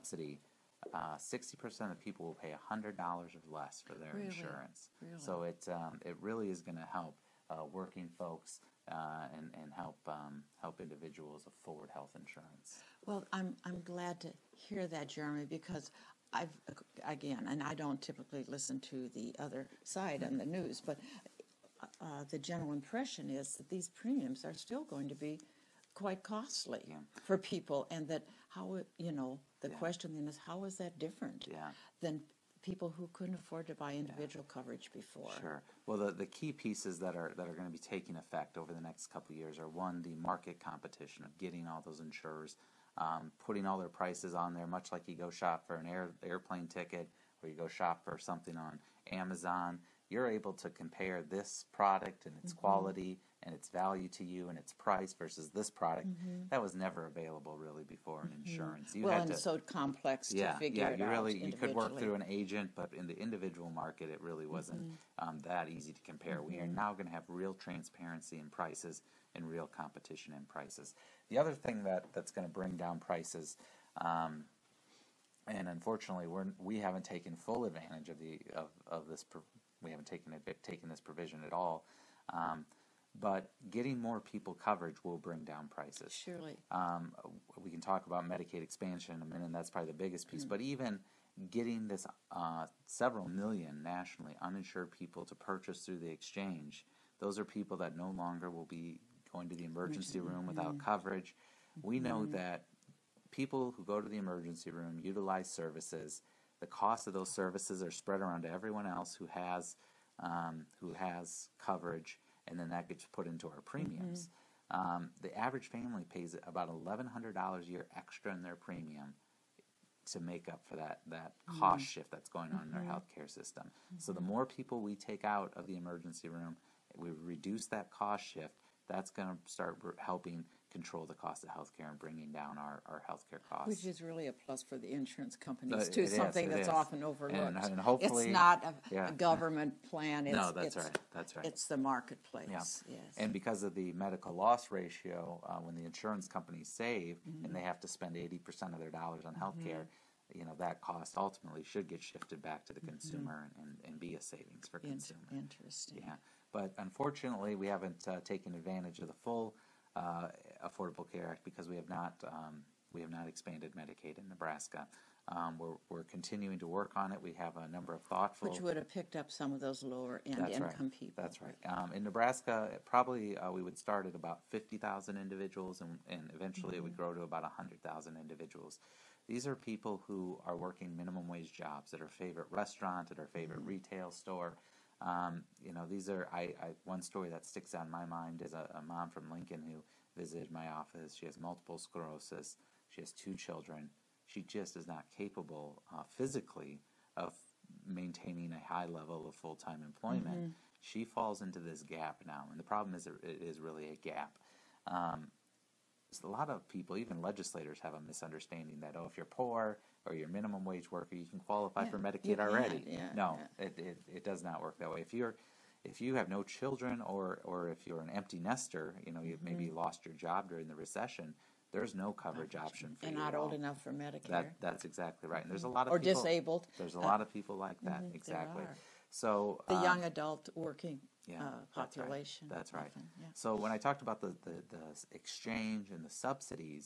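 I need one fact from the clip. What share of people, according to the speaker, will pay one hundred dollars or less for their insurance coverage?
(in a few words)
60%.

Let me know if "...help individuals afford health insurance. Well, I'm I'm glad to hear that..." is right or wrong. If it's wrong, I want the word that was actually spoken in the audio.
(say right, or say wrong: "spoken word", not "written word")
right.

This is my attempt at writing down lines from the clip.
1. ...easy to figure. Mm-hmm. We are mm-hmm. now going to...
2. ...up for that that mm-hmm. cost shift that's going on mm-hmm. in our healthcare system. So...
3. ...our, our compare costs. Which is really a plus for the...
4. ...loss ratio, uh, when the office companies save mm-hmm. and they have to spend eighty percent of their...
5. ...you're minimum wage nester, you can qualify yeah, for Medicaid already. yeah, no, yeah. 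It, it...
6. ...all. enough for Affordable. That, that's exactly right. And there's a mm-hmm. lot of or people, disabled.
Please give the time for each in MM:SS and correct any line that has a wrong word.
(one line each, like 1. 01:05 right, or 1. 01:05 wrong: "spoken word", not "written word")
1. 01:05 wrong: "compare", not "figure"
2. 02:00 right
3. 02:12 wrong: "healthcare", not "compare"
4. 02:24 wrong: "insurance", not "office"
5. 03:30 wrong: "worker", not "nester"
6. 03:43 wrong: "Medicare", not "Affordable".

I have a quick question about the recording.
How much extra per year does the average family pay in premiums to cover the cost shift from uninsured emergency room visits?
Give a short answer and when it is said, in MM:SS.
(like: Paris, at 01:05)
$1,100, at 01:56.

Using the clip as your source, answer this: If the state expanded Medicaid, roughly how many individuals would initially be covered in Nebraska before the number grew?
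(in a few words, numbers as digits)
50,000.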